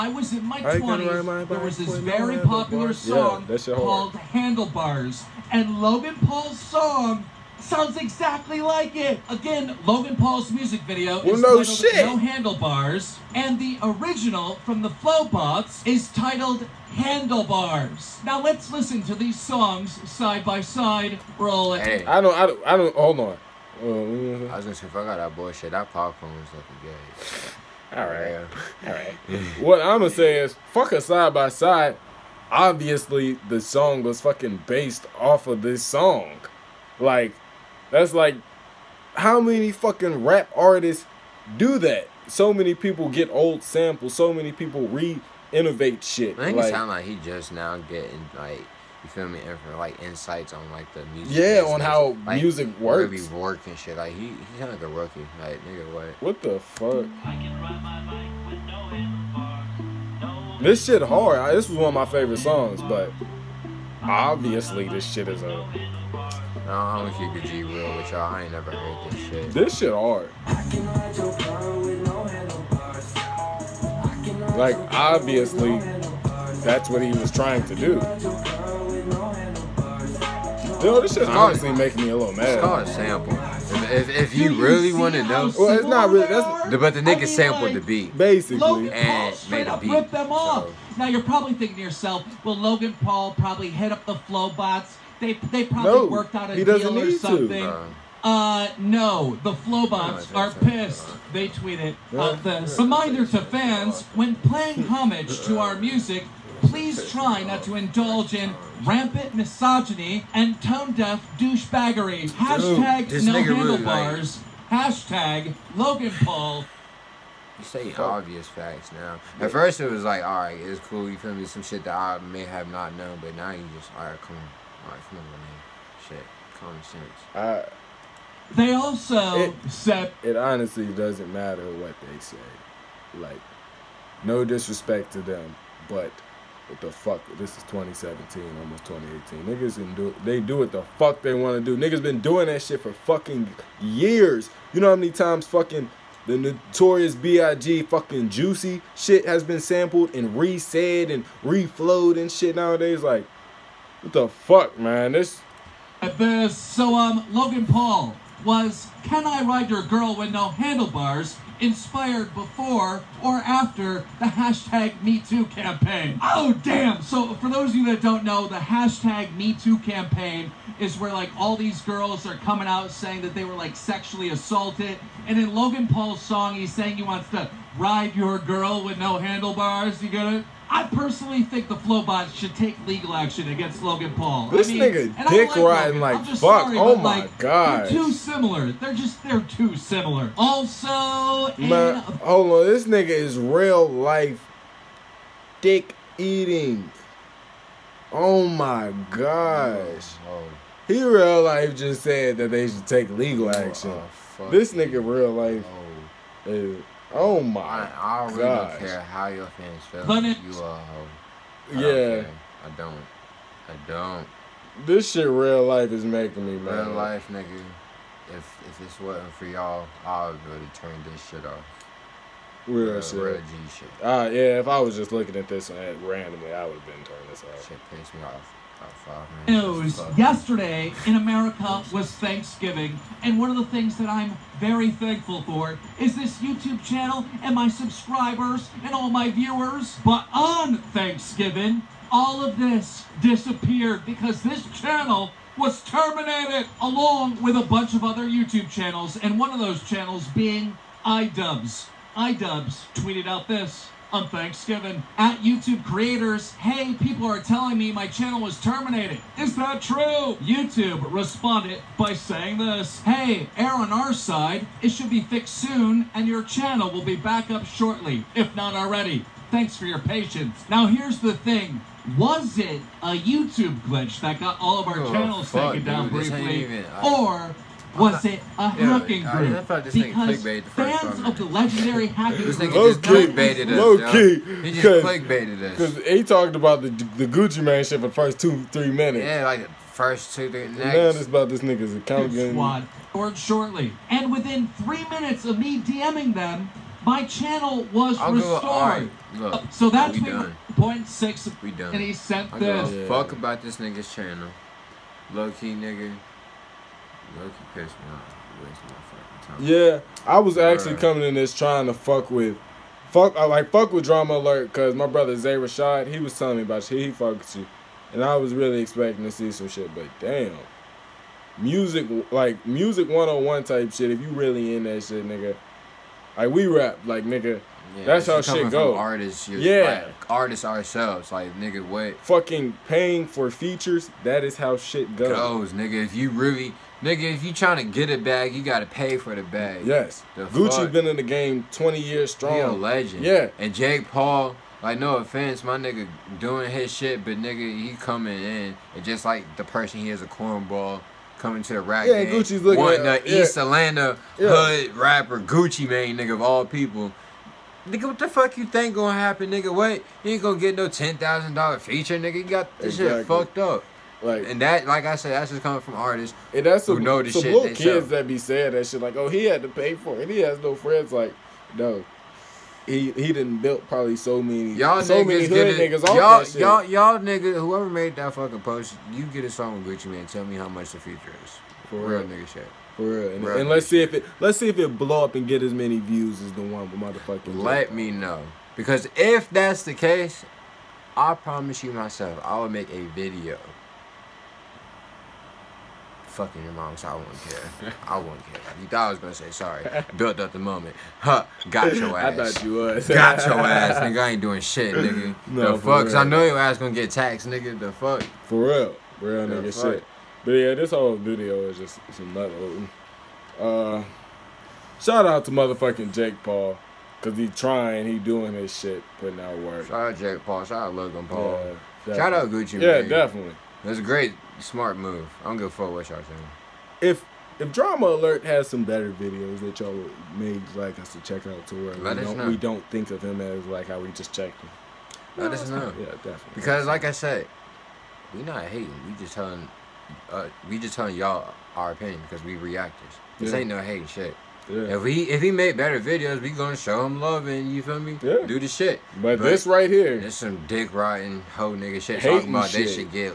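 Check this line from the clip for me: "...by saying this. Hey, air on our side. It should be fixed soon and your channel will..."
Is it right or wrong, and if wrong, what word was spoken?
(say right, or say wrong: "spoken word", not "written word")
right.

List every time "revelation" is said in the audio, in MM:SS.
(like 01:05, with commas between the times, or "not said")
not said.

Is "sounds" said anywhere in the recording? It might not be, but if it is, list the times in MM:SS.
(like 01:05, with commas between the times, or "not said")
00:07, 00:46, 00:54.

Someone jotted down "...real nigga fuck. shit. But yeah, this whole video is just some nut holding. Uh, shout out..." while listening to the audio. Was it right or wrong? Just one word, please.
right.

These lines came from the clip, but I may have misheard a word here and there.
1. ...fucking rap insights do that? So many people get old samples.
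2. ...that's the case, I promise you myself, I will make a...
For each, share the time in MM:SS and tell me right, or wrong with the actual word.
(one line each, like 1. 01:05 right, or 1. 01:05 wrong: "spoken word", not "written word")
1. 00:39 wrong: "artists", not "insights"
2. 06:29 right.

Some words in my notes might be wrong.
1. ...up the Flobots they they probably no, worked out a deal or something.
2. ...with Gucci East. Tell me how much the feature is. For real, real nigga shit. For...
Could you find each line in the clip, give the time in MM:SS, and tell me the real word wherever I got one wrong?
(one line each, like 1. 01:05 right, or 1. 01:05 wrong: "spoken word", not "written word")
1. 01:33 right
2. 06:19 wrong: "Mane", not "East".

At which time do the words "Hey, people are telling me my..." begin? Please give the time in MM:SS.
04:16.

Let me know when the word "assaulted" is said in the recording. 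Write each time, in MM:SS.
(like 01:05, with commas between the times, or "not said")
02:54.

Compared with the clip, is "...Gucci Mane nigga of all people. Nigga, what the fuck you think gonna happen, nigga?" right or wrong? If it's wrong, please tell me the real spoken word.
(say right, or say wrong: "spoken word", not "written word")
right.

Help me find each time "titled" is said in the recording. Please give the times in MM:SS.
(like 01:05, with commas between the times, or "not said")
00:11, 00:16.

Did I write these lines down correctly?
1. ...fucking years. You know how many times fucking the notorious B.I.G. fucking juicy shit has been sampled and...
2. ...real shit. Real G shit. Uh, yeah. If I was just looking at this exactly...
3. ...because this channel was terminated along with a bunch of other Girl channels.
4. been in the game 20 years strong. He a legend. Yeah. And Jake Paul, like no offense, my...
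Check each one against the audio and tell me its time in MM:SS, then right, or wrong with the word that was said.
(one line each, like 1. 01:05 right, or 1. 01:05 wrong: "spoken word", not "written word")
1. 02:22 right
2. 03:42 wrong: "randomly", not "exactly"
3. 04:04 wrong: "YouTube", not "Girl"
4. 05:40 right.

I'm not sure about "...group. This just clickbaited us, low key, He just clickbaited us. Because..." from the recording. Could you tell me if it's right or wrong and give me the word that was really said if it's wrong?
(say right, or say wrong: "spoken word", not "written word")
right.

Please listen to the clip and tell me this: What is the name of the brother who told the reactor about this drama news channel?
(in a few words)
Zay Rashad.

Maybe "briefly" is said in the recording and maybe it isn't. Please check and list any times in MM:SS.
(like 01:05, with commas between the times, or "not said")
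04:36.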